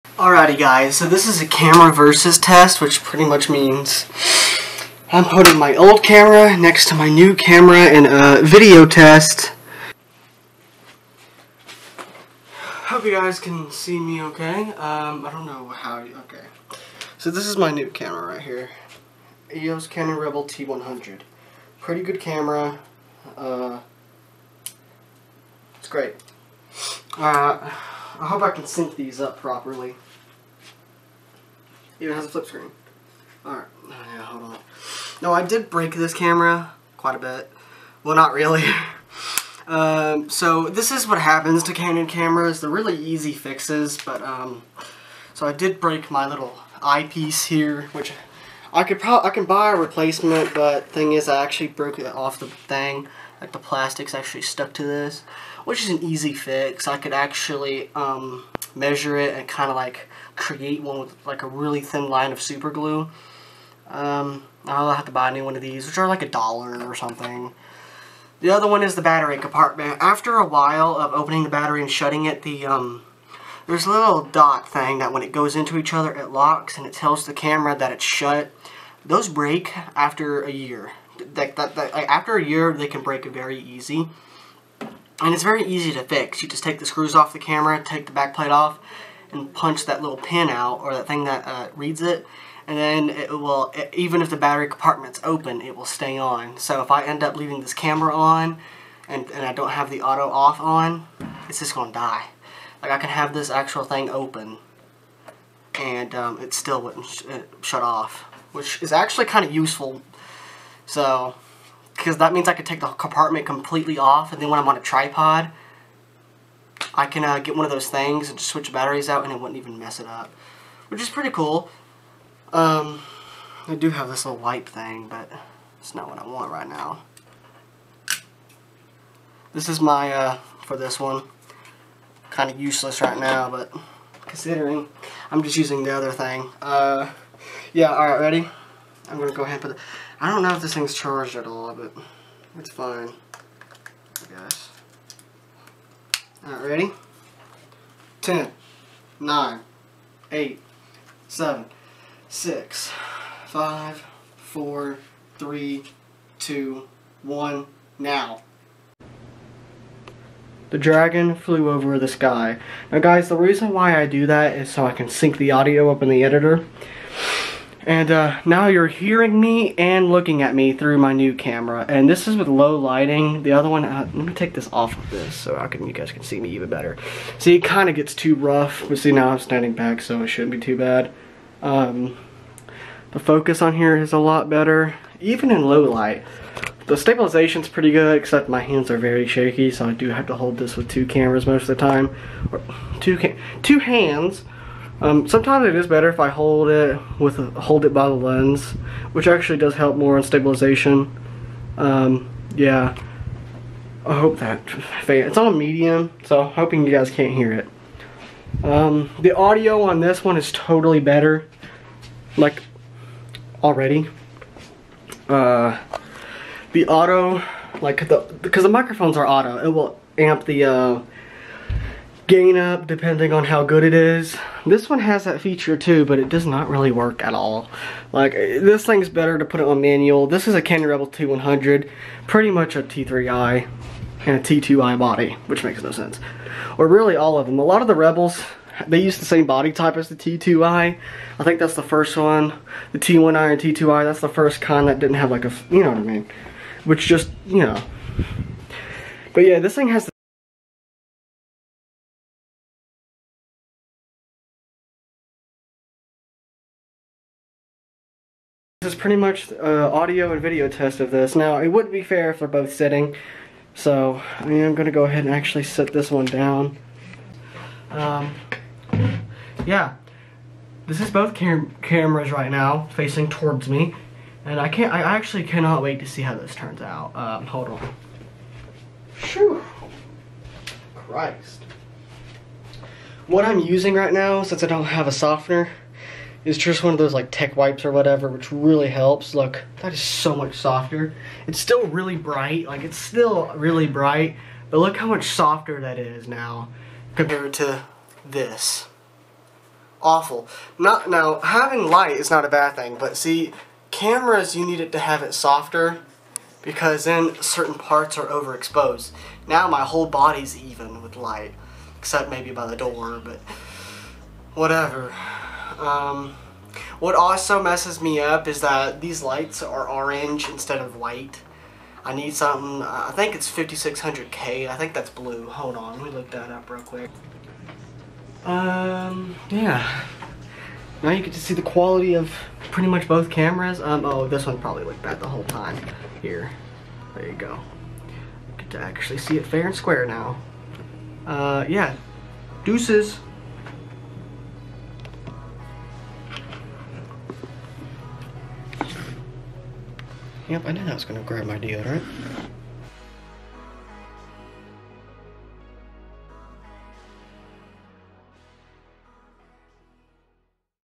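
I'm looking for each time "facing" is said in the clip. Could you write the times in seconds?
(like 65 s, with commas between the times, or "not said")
272 s.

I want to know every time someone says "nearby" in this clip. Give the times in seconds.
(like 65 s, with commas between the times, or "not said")
not said.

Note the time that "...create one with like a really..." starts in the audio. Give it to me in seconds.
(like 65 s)
60 s.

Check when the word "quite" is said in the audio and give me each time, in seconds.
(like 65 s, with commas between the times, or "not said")
36 s.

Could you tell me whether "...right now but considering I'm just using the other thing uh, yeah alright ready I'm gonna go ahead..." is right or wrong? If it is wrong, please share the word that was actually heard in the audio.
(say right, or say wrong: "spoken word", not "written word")
right.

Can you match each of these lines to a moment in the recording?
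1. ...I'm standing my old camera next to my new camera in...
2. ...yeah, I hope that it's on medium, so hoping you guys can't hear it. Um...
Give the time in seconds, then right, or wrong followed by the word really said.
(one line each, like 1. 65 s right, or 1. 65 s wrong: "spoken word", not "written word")
1. 5 s wrong: "putting", not "standing"
2. 202 s right.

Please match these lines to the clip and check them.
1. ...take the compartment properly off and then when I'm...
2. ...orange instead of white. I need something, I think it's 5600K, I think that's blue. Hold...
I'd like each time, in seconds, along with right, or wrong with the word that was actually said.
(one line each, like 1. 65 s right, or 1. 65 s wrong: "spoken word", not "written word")
1. 112 s wrong: "completely", not "properly"
2. 319 s right.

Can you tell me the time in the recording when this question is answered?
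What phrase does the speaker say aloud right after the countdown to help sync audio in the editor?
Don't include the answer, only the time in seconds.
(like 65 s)
160 s.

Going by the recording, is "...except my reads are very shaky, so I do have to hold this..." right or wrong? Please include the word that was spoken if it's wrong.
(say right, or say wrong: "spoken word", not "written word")
wrong: "hands", not "reads".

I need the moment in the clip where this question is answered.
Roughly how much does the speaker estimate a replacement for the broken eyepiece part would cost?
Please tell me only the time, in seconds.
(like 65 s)
66 s.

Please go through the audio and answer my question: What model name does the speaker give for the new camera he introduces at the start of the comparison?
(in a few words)
Canon Rebel T100.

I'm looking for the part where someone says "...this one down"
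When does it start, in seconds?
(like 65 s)
265 s.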